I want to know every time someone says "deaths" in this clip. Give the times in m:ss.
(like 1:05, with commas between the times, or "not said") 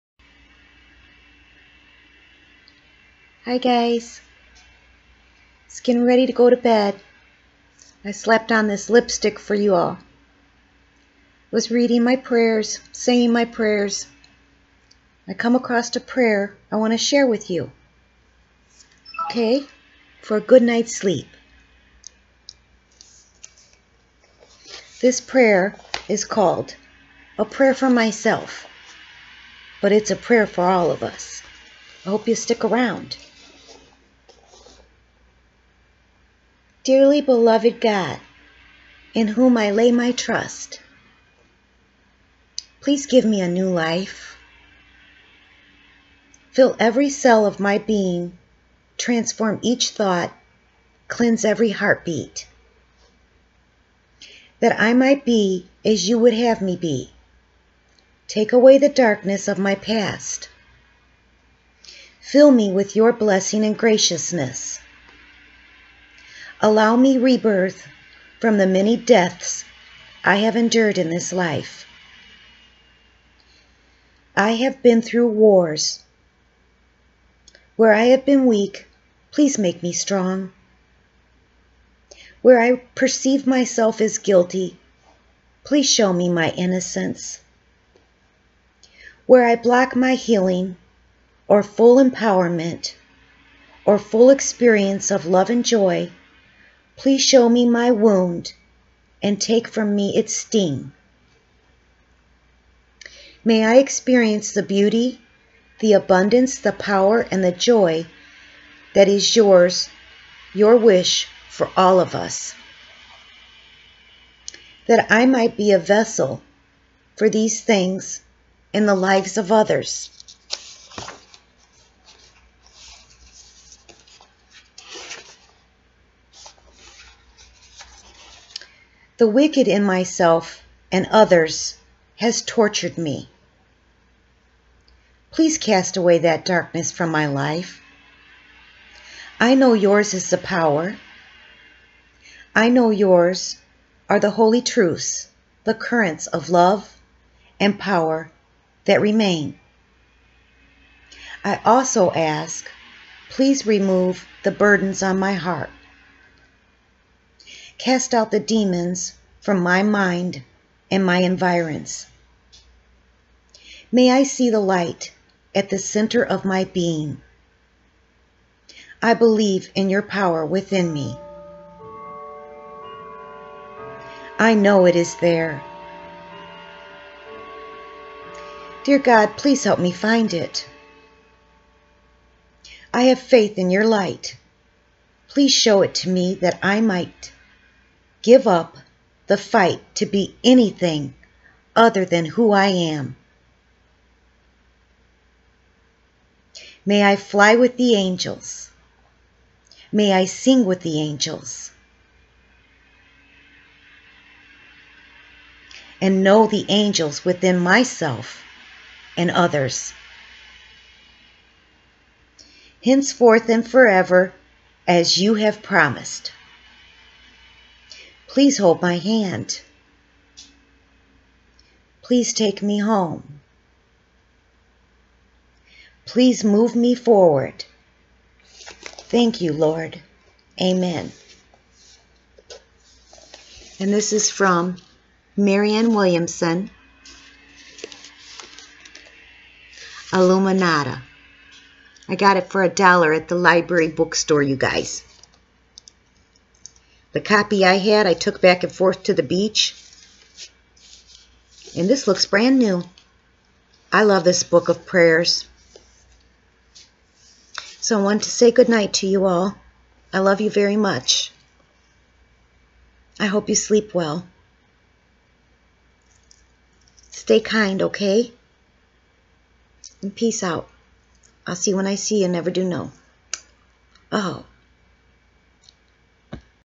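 1:08.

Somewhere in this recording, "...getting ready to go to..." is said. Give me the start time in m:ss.
0:05.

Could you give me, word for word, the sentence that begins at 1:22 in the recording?
Where I perceive myself as guilty, please show me my innocence.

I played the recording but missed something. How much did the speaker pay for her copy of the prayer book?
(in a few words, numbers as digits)
$1.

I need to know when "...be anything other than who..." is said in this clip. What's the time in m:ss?
3:10.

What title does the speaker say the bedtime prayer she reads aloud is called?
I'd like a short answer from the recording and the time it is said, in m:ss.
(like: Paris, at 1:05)
A prayer for myself, at 0:27.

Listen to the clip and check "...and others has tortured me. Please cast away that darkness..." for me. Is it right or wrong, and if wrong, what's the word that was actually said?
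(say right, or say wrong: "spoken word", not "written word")
right.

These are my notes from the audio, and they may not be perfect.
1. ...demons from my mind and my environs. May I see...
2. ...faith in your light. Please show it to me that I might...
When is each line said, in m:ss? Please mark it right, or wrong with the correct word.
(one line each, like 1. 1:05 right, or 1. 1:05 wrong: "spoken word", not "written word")
1. 2:38 right
2. 3:03 right.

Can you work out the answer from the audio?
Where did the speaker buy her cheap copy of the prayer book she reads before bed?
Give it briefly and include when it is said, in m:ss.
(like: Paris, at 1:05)
Library bookstore, at 4:03.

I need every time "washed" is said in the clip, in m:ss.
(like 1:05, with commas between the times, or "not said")
not said.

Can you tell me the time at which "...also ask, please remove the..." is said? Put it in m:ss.
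2:31.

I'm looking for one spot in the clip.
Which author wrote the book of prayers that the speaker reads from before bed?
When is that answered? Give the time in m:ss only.
3:55.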